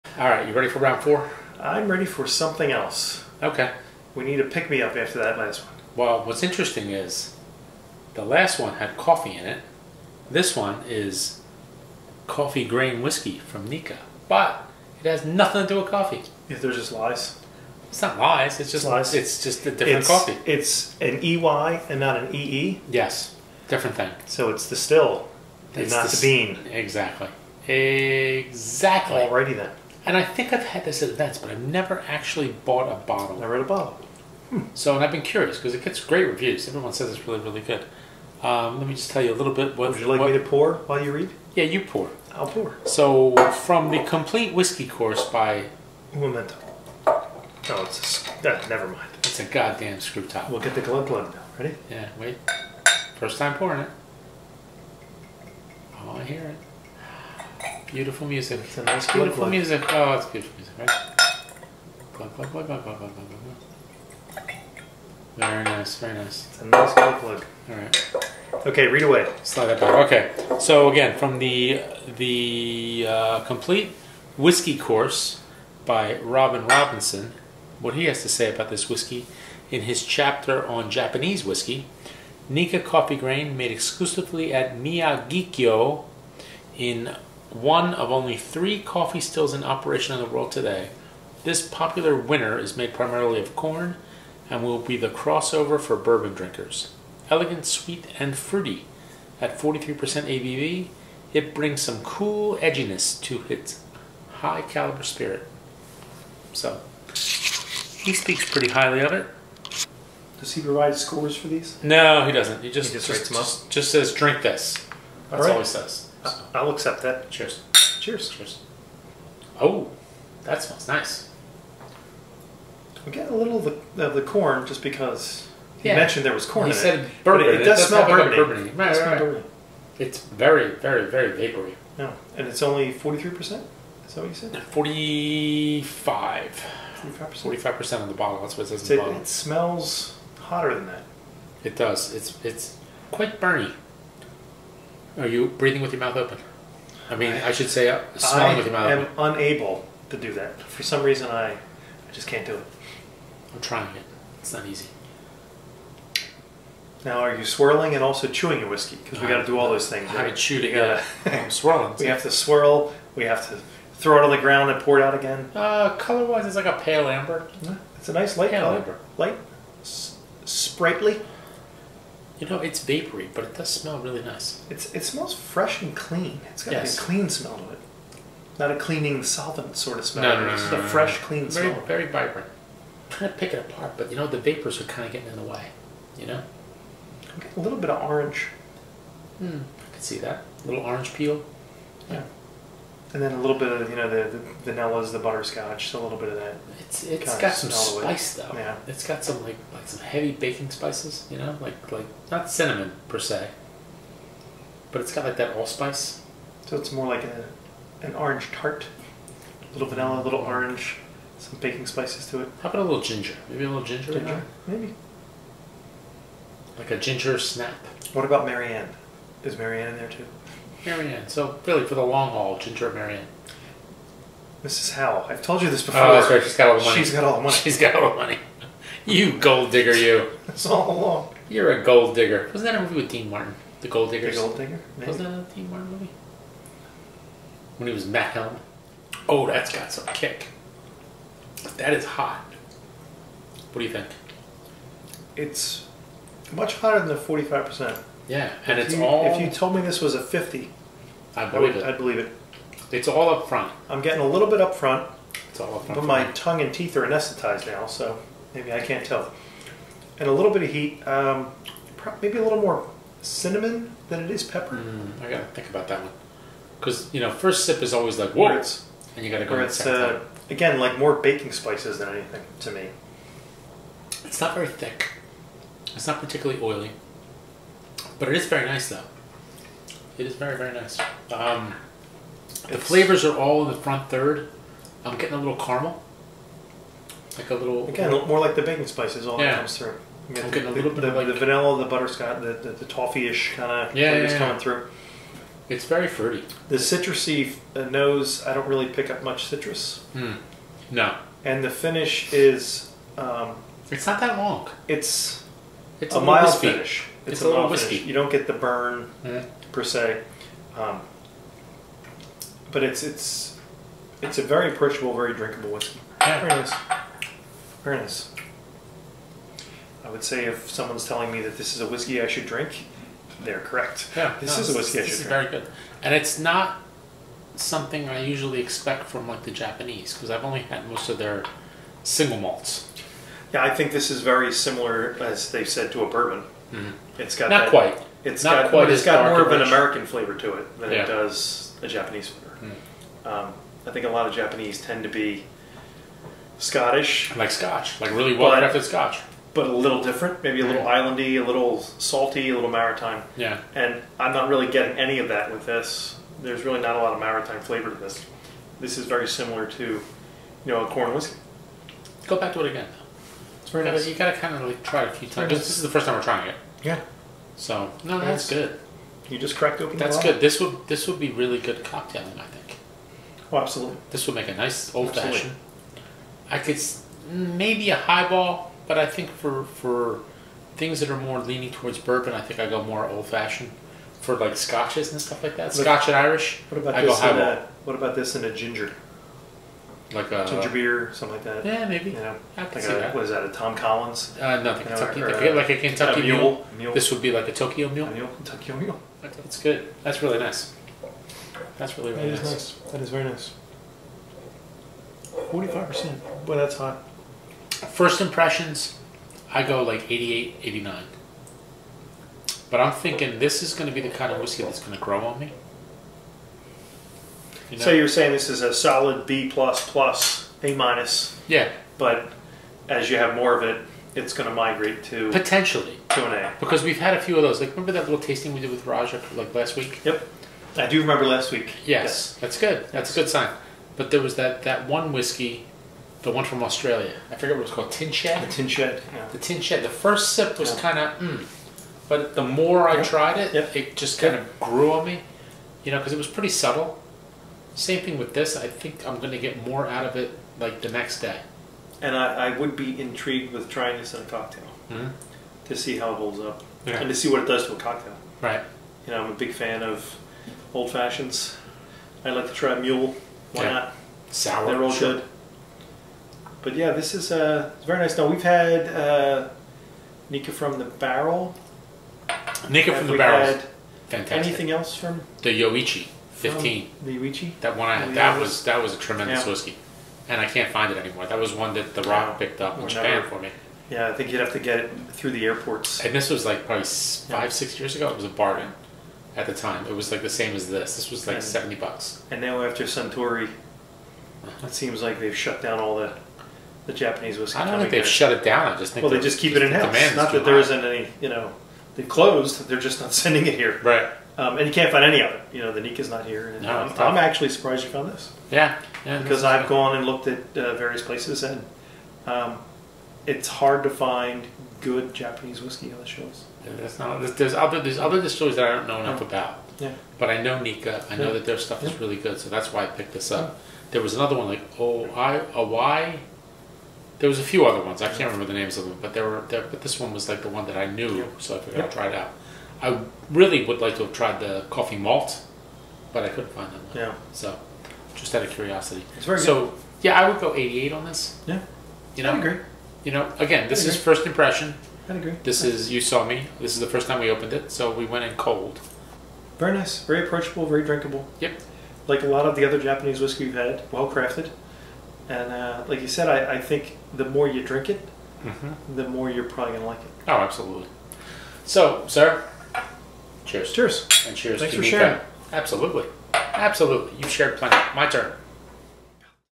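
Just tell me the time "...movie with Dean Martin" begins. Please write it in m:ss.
3:52.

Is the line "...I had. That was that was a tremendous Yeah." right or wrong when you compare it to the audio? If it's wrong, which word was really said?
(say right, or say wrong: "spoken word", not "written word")
right.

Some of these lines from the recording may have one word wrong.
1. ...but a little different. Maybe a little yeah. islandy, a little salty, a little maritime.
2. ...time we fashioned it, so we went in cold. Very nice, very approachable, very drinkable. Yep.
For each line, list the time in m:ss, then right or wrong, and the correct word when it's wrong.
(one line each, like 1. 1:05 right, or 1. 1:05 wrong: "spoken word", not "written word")
1. 5:49 right
2. 9:07 wrong: "opened", not "fashioned".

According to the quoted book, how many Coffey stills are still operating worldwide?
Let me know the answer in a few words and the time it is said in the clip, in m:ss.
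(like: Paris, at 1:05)
3, at 1:28.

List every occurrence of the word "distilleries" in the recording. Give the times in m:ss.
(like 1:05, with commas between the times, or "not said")
8:38.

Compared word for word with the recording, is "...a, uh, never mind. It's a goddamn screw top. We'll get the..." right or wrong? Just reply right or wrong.
right.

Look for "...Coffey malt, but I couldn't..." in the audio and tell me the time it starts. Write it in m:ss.
8:54.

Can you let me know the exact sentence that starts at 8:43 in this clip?
There was another one like oh I a why.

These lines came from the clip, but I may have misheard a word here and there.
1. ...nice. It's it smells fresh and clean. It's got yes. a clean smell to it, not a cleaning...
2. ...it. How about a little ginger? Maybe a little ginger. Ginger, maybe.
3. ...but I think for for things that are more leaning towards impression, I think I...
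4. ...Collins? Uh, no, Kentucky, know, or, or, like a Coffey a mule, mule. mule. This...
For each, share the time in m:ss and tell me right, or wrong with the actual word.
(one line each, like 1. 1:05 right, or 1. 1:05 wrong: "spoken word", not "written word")
1. 2:54 right
2. 3:32 right
3. 6:18 wrong: "bourbon", not "impression"
4. 6:33 wrong: "Kentucky", not "Coffey".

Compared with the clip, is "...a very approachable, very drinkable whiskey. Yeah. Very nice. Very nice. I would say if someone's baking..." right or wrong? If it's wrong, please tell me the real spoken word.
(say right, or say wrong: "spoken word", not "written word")
wrong: "telling", not "baking".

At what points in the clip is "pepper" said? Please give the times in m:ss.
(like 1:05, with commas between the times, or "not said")
4:24.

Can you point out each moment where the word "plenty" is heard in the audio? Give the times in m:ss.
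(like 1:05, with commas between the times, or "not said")
9:27.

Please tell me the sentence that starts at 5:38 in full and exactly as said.
It's got more of an American flavor to it than yeah.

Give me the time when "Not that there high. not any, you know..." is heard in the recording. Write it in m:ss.
8:20.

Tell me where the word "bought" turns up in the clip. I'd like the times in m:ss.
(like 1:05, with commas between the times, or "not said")
0:32.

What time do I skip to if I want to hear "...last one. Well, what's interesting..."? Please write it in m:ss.
0:05.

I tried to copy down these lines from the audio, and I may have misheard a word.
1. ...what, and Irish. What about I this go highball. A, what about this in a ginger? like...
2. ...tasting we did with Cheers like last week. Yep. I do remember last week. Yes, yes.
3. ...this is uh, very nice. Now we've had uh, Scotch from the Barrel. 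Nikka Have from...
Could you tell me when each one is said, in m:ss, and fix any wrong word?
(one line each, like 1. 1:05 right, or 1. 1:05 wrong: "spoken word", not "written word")
1. 6:26 right
2. 7:08 wrong: "Raja", not "Cheers"
3. 7:46 wrong: "Nikka", not "Scotch".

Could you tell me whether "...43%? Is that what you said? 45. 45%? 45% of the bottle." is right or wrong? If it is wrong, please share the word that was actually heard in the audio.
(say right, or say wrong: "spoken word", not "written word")
right.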